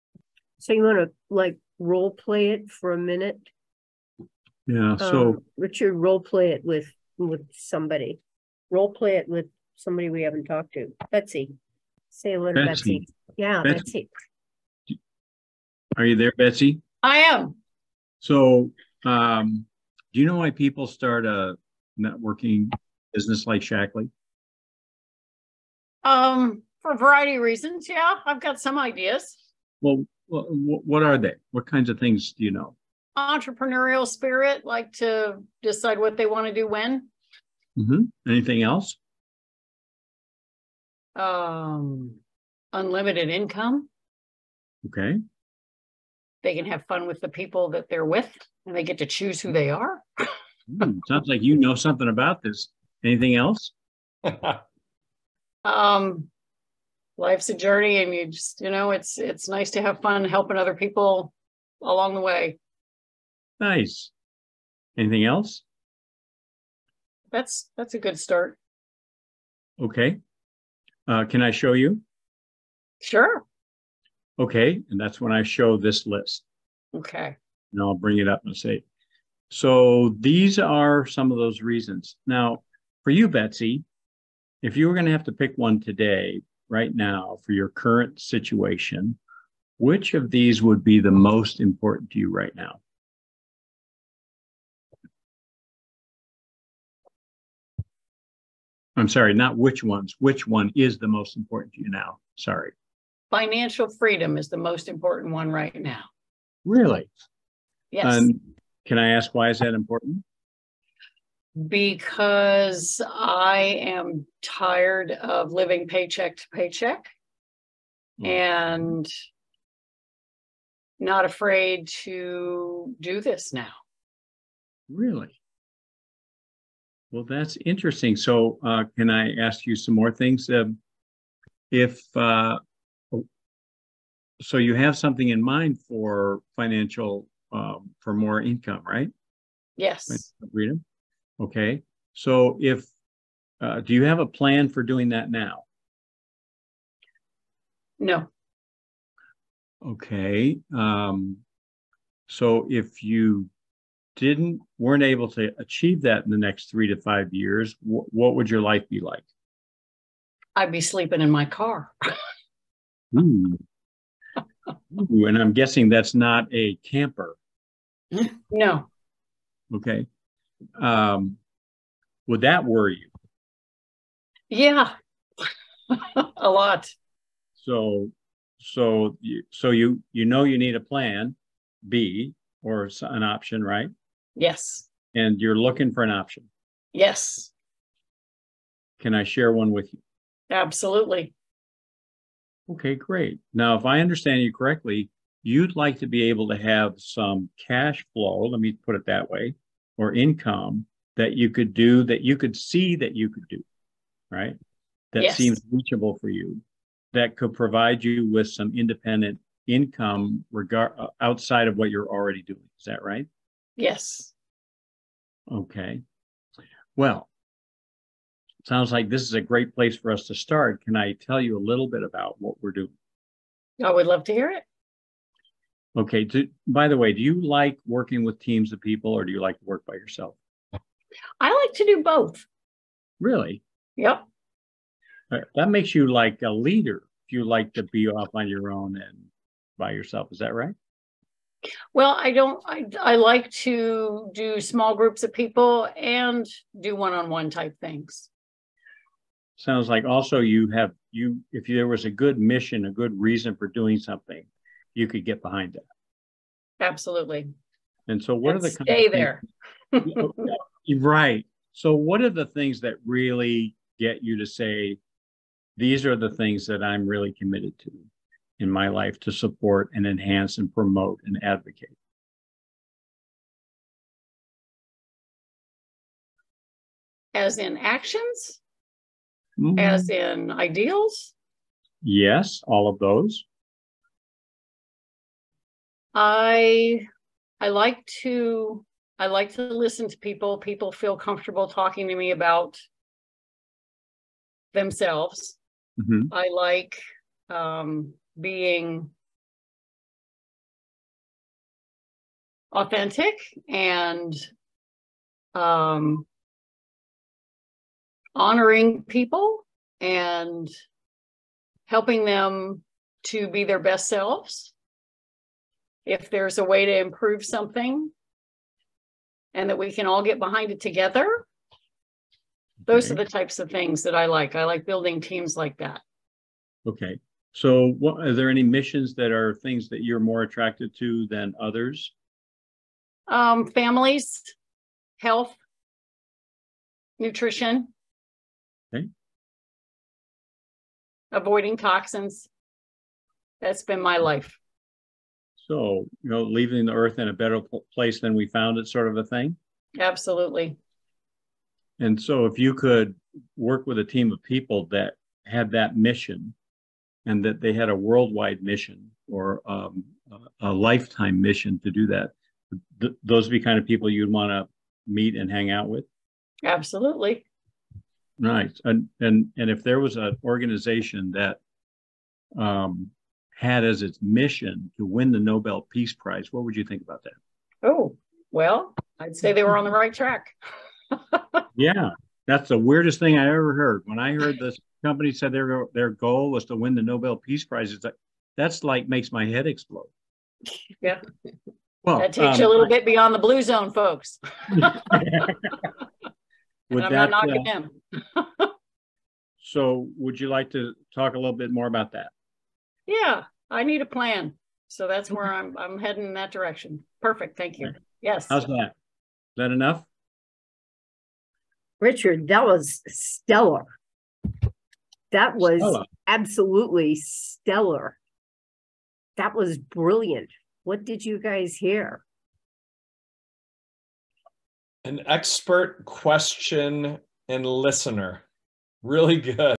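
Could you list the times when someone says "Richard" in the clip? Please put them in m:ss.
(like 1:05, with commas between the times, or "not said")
0:05, 6:51.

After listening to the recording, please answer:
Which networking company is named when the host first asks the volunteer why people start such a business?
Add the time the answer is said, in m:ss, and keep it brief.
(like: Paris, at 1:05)
Shaklee, at 0:23.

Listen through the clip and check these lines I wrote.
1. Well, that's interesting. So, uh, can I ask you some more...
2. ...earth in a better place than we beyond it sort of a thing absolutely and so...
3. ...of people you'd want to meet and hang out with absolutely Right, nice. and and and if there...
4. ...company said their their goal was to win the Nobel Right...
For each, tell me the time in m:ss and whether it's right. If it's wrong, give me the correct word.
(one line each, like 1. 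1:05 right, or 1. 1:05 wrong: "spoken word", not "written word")
1. 2:07 right
2. 5:46 wrong: "found", not "beyond"
3. 6:03 right
4. 6:25 wrong: "Peace", not "Right".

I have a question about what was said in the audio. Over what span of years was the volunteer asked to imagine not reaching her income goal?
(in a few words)
3 to 5 years.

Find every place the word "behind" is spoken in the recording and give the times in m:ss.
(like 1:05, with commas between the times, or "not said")
4:15, 5:20.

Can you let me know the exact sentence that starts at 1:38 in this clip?
I'm sorry, not which ones, which one is the most important to you now?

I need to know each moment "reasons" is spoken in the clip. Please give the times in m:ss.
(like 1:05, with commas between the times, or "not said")
0:27, 1:21, 4:13.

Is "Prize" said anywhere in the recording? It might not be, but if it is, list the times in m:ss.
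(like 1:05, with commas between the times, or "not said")
6:16, 6:27.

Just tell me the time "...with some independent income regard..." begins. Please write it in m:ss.
3:28.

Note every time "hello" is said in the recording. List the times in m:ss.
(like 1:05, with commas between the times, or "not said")
0:12.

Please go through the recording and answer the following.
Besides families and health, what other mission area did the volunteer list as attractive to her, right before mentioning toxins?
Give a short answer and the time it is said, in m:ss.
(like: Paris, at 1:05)
Nutrition, at 5:37.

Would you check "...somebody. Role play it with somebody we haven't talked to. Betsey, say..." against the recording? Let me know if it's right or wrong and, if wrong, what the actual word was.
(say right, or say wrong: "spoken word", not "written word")
right.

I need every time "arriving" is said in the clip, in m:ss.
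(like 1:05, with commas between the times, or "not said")
not said.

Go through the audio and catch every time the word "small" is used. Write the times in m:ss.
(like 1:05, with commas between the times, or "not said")
4:04.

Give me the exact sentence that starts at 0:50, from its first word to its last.
mm, sounds like you know something about this.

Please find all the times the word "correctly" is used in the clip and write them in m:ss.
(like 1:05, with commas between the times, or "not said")
3:14.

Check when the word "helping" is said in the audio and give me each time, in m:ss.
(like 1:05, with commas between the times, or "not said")
1:00, 5:11.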